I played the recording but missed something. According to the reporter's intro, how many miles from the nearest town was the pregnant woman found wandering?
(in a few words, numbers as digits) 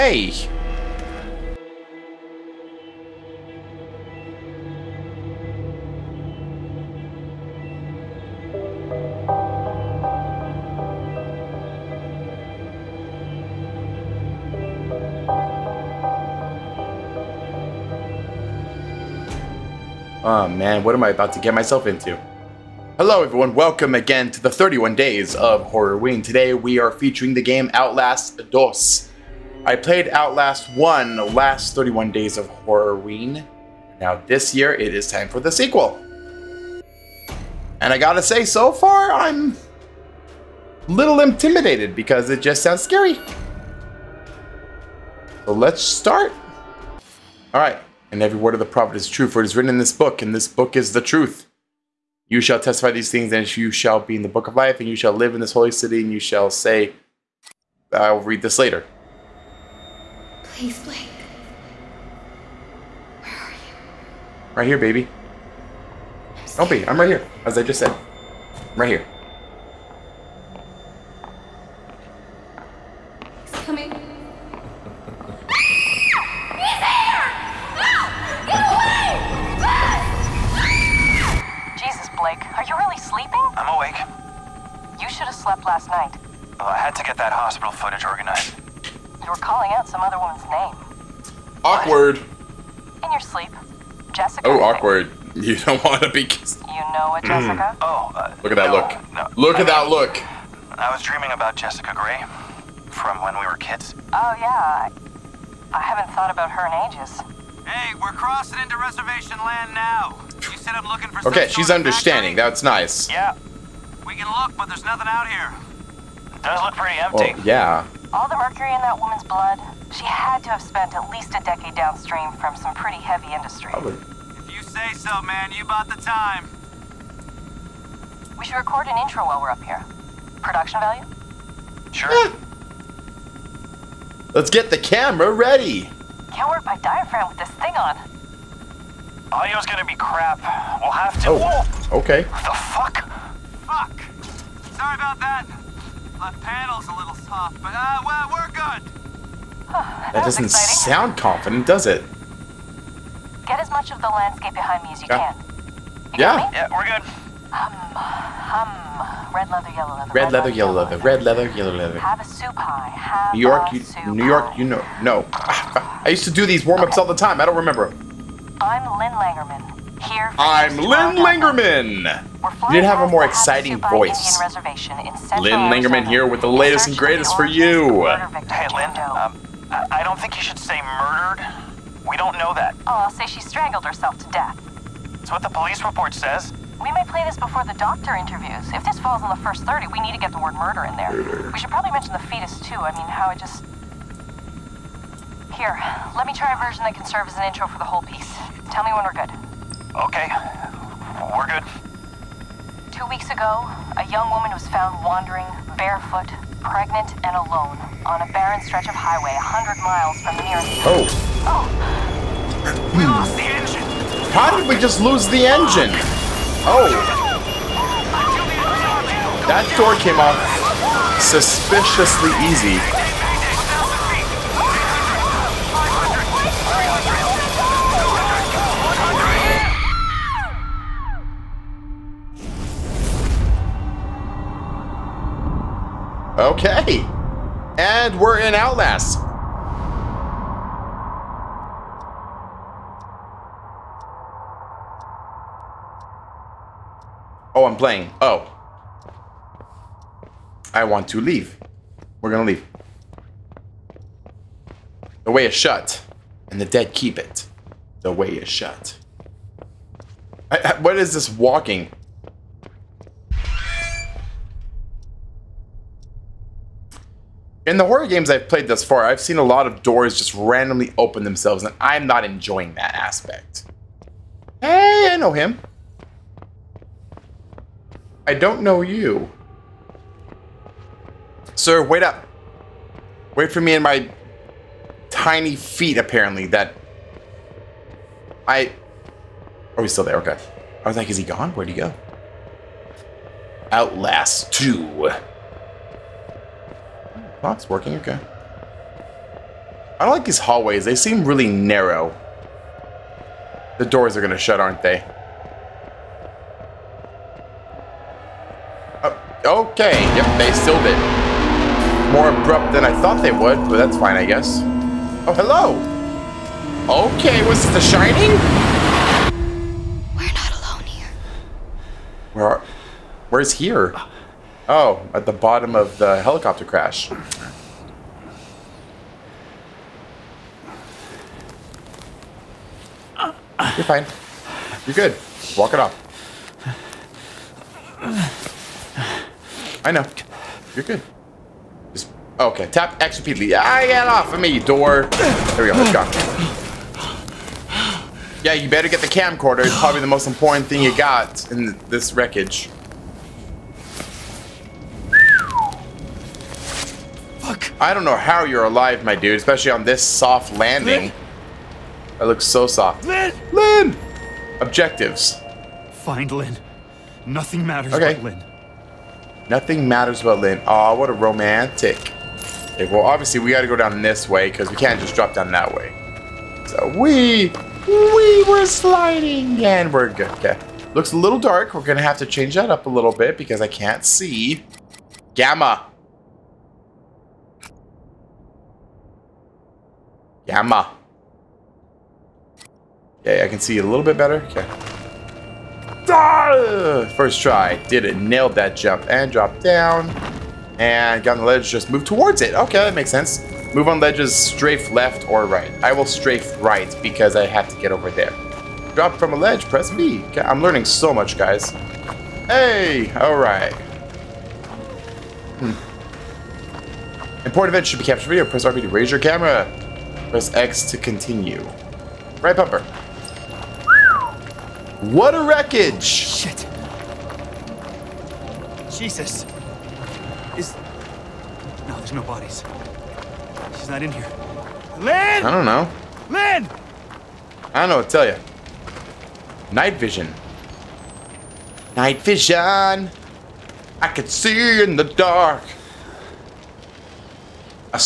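100.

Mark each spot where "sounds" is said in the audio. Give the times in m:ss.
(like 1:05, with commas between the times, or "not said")
0:42, 2:30.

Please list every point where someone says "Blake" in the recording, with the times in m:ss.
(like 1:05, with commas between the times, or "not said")
1:00, 1:22.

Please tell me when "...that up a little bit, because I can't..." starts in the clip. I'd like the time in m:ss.
6:22.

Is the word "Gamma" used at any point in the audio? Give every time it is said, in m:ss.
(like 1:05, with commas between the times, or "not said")
6:25, 6:30.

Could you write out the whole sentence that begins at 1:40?
I was dreaming about Jessica Gray from when we were kids.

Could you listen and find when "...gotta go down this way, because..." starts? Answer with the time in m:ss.
6:13.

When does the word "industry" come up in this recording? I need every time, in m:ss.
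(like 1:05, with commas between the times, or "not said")
2:03.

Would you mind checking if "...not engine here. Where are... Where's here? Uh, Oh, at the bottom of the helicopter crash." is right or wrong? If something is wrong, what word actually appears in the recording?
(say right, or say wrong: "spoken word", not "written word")
wrong: "alone", not "engine".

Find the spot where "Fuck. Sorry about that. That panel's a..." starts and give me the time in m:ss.
2:23.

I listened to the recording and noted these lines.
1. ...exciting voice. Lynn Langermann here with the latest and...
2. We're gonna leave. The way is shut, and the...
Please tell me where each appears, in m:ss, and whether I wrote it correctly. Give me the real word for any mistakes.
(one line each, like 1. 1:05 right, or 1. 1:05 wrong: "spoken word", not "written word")
1. 2:53 right
2. 4:12 right.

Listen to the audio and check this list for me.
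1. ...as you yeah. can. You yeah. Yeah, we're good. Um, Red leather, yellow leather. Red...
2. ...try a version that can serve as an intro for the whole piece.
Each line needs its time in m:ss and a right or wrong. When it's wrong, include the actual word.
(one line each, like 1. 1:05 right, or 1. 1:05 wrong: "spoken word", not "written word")
1. 2:34 right
2. 3:16 right.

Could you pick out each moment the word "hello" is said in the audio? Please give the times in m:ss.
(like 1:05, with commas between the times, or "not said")
0:22, 5:15.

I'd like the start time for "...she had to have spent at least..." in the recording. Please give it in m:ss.
1:59.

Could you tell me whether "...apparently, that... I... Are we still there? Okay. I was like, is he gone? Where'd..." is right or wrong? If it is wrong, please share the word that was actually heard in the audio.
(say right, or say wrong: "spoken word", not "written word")
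right.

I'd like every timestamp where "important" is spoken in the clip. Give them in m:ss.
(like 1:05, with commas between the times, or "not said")
5:50, 6:57.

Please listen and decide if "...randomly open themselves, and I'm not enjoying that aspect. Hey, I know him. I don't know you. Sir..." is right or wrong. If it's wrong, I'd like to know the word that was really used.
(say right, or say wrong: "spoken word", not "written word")
right.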